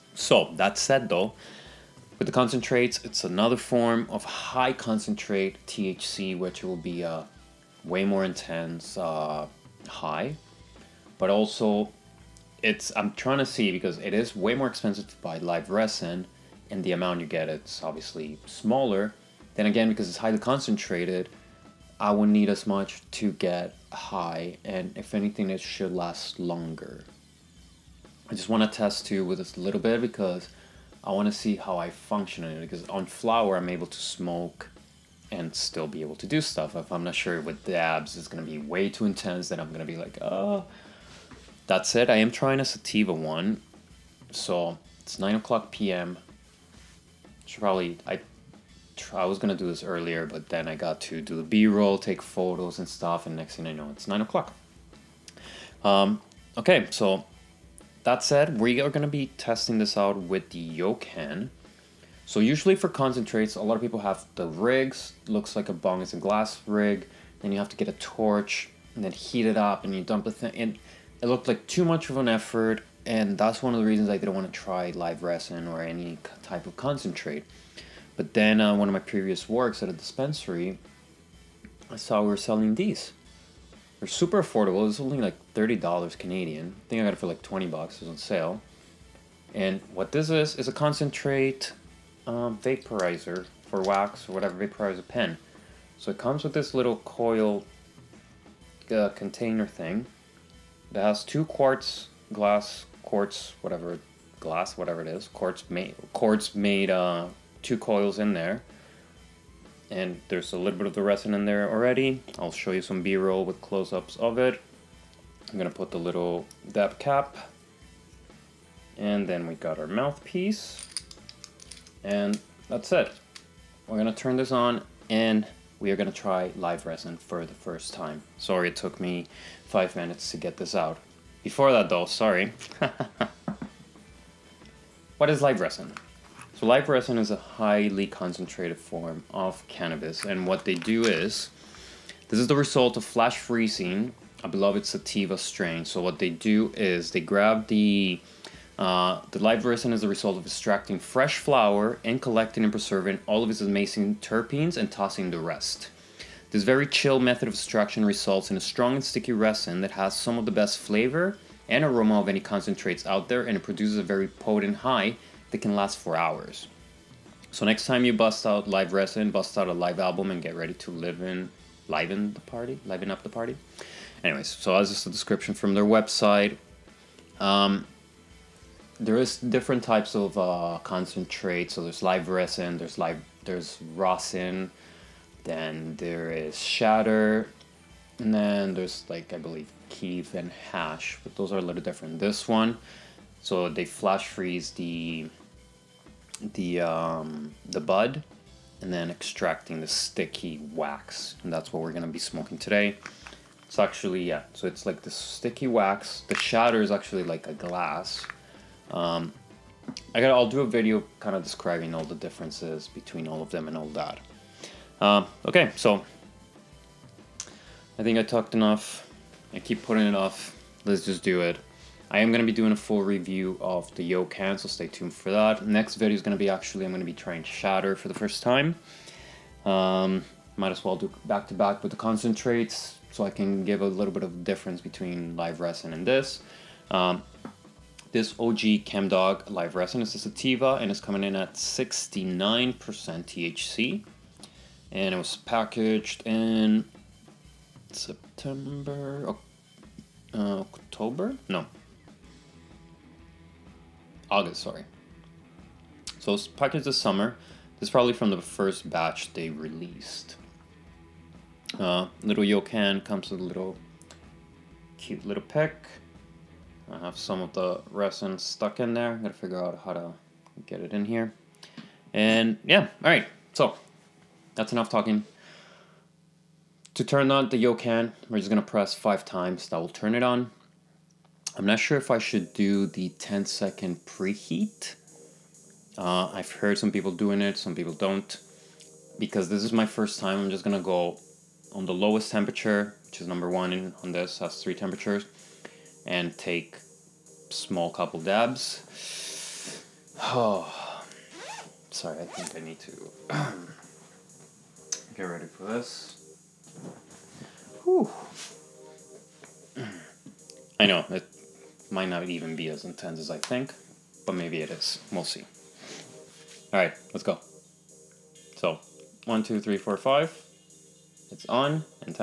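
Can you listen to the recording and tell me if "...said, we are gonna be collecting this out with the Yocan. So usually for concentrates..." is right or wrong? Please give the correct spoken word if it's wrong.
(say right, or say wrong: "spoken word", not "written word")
wrong: "testing", not "collecting".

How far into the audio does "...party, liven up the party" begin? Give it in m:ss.
2:52.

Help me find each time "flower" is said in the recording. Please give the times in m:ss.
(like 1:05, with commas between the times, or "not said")
0:33, 2:31.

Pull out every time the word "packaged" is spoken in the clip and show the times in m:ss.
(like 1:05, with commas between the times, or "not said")
4:05, 4:16.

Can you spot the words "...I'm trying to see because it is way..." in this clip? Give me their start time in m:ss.
0:12.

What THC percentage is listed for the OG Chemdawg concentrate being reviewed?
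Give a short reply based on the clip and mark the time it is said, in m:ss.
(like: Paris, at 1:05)
69%, at 4:01.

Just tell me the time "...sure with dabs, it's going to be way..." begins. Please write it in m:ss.
0:37.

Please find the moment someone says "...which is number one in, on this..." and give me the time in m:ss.
4:53.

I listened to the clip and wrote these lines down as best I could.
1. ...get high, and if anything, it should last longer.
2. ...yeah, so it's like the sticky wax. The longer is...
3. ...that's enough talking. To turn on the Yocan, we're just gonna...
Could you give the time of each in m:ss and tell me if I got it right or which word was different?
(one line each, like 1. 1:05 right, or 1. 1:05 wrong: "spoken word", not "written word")
1. 0:23 right
2. 3:24 wrong: "shatter", not "longer"
3. 4:34 right.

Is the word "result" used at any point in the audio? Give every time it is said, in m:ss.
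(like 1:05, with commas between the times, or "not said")
2:22, 2:30, 2:38.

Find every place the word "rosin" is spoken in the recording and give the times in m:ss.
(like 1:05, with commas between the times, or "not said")
3:03.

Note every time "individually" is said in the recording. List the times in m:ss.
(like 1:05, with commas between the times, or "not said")
not said.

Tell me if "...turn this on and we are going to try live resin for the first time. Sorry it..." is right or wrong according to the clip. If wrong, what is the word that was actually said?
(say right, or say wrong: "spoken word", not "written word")
right.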